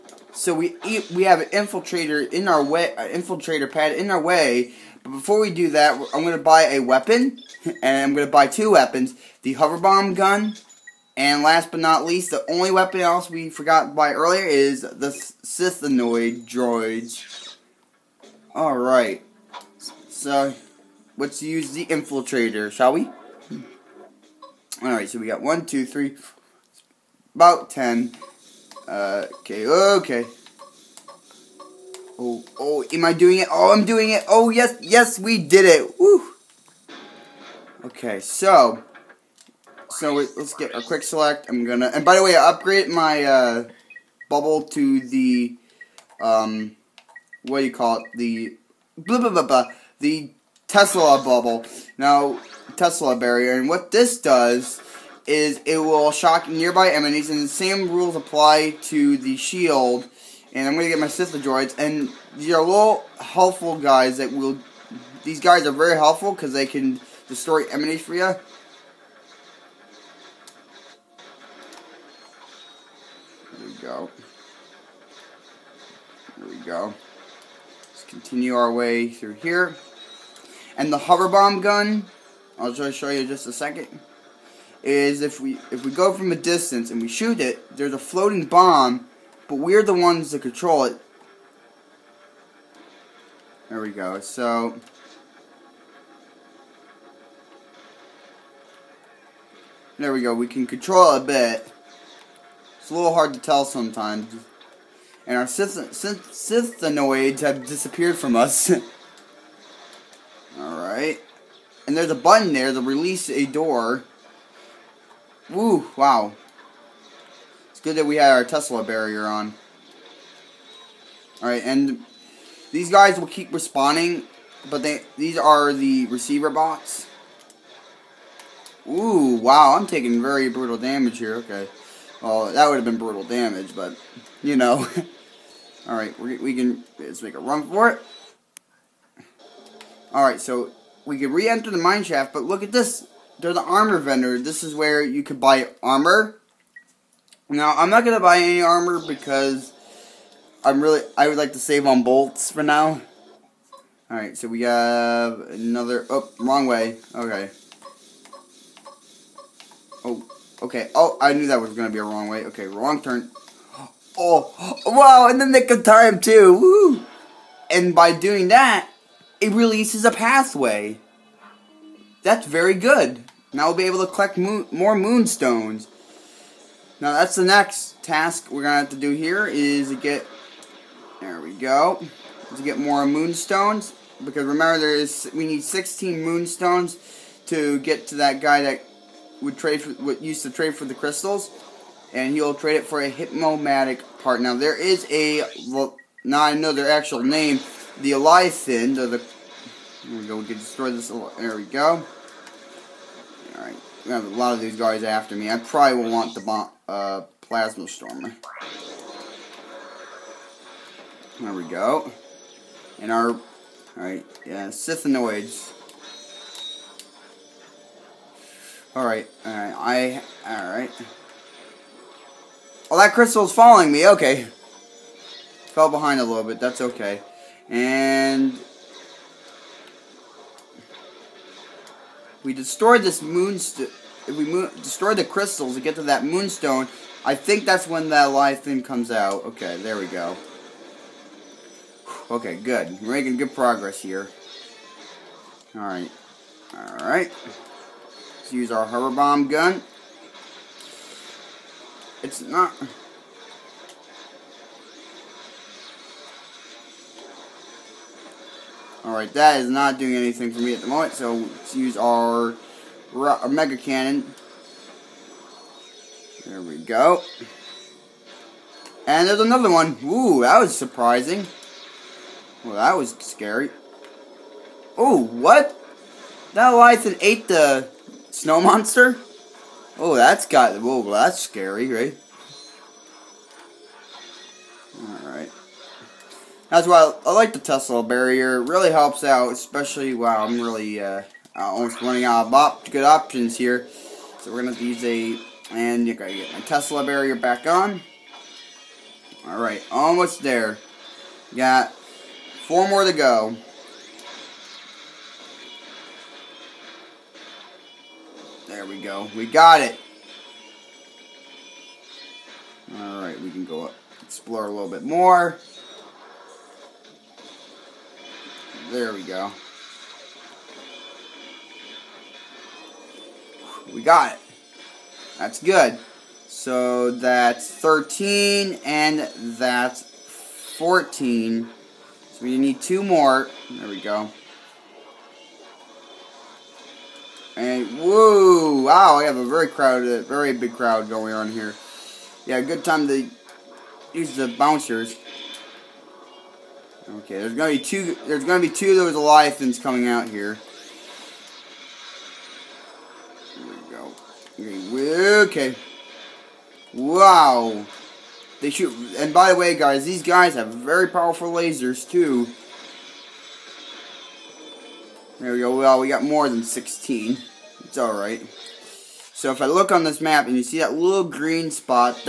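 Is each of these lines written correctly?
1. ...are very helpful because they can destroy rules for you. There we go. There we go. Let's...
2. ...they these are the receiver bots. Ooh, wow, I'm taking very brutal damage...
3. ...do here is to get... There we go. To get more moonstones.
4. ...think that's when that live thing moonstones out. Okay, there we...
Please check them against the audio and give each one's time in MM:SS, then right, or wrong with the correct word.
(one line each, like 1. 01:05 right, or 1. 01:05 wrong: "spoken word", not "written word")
1. 01:05 wrong: "enemies", not "rules"
2. 02:04 right
3. 02:58 right
4. 03:57 wrong: "comes", not "moonstones".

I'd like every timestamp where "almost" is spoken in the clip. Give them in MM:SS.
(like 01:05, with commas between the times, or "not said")
04:51, 04:59.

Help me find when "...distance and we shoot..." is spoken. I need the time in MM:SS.
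01:26.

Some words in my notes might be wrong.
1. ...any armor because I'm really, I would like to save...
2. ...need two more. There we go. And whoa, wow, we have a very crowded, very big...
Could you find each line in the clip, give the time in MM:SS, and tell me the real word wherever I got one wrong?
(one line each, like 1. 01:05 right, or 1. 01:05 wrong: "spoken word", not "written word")
1. 02:28 right
2. 05:32 right.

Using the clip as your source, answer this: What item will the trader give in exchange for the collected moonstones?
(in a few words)
Hypnomatic part.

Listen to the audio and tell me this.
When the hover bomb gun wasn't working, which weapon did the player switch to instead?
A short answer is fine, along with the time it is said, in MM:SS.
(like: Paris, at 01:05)
Mega Cannon, at 04:23.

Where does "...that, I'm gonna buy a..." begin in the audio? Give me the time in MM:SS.
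00:05.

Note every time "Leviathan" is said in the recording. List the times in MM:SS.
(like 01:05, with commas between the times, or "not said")
03:18, 04:36, 05:49.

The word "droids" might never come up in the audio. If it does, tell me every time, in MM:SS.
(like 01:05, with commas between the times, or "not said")
00:16, 01:01.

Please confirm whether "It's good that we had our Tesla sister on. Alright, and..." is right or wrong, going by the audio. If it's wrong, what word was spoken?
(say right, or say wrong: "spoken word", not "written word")
wrong: "barrier", not "sister".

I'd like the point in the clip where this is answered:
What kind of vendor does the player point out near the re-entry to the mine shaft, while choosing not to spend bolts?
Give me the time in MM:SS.
02:23.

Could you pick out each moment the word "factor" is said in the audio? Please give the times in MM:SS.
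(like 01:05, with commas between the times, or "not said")
not said.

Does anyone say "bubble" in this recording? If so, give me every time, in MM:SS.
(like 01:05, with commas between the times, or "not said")
00:44, 00:51.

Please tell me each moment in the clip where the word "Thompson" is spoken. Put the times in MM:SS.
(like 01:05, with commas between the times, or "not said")
not said.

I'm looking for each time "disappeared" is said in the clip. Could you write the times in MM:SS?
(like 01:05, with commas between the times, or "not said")
01:47.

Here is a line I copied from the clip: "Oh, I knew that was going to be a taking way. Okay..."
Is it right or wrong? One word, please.
wrong.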